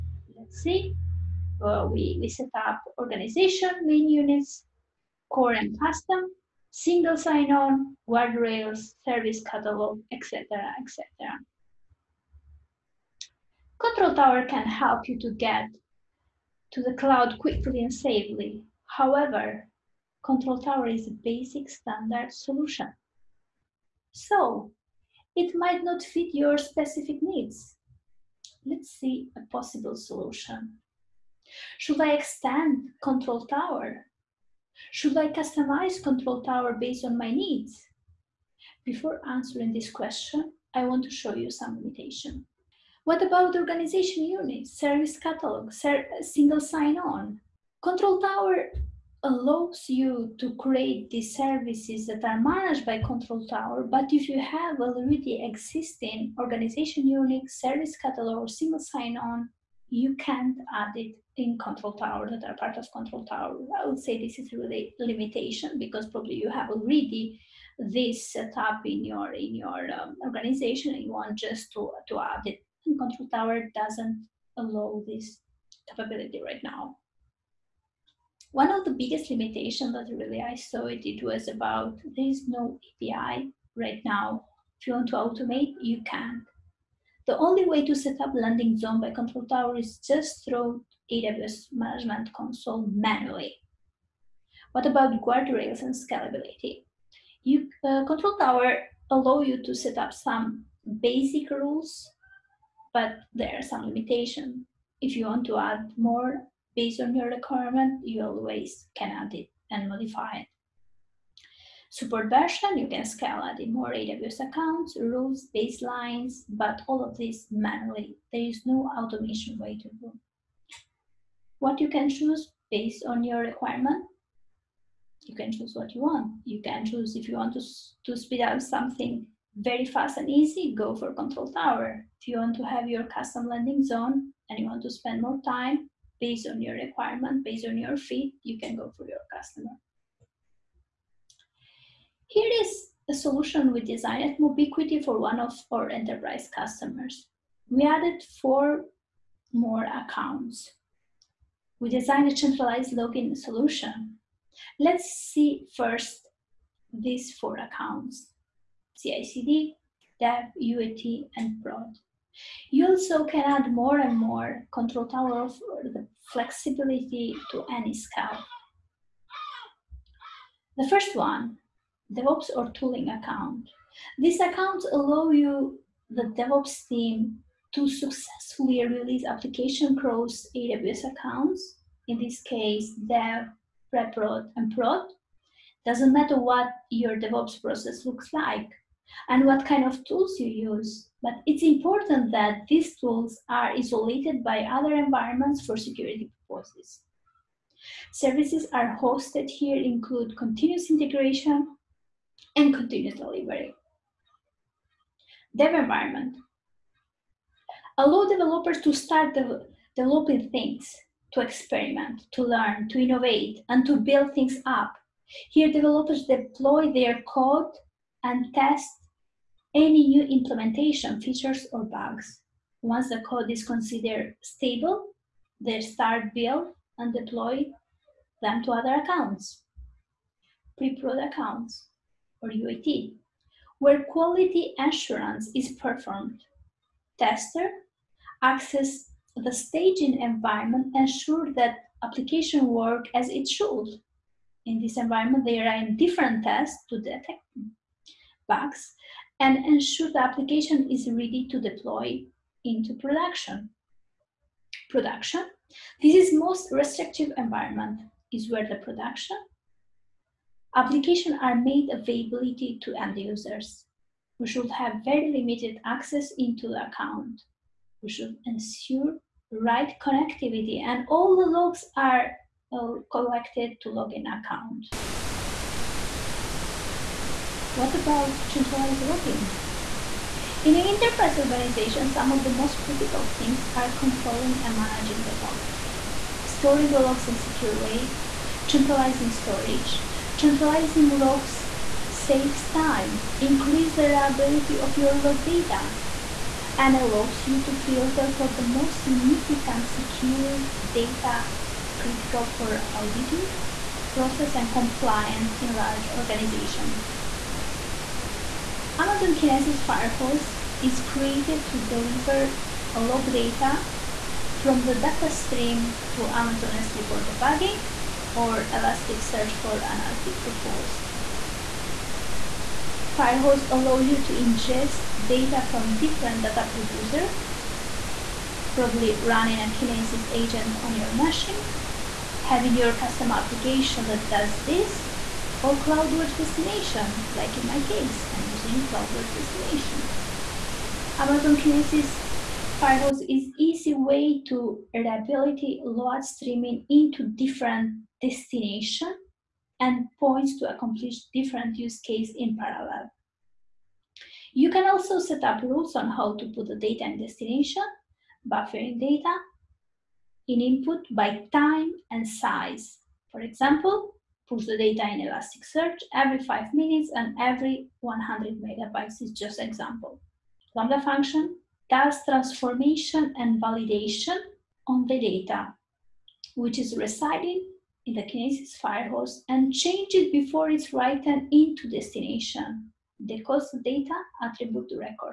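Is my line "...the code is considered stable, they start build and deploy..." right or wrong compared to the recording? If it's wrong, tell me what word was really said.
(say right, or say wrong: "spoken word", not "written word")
right.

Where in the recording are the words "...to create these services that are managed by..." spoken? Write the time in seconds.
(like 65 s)
50 s.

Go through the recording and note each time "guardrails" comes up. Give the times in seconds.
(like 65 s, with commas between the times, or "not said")
8 s, 95 s.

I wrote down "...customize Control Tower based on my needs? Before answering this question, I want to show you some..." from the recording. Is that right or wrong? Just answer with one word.
right.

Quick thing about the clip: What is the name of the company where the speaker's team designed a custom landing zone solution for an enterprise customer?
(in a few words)
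Mobiquity.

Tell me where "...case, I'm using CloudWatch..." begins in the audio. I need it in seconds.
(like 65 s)
337 s.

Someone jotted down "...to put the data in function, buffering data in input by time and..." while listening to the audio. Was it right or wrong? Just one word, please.
wrong.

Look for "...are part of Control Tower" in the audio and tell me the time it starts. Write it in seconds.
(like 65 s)
62 s.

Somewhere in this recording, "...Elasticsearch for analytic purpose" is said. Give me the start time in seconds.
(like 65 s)
318 s.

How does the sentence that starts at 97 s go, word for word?
You, uh, control tower allow you to set up some basic rules but there are some limitations.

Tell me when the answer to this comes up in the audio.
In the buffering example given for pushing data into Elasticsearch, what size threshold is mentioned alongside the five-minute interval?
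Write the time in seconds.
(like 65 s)
368 s.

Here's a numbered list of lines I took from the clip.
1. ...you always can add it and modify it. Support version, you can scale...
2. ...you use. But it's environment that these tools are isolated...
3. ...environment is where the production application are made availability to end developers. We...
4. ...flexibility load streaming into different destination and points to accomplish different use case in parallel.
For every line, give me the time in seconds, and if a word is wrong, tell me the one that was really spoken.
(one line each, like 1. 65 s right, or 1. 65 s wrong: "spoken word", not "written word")
1. 108 s right
2. 190 s wrong: "important", not "environment"
3. 257 s wrong: "users", not "developers"
4. 344 s wrong: "reliability", not "flexibility".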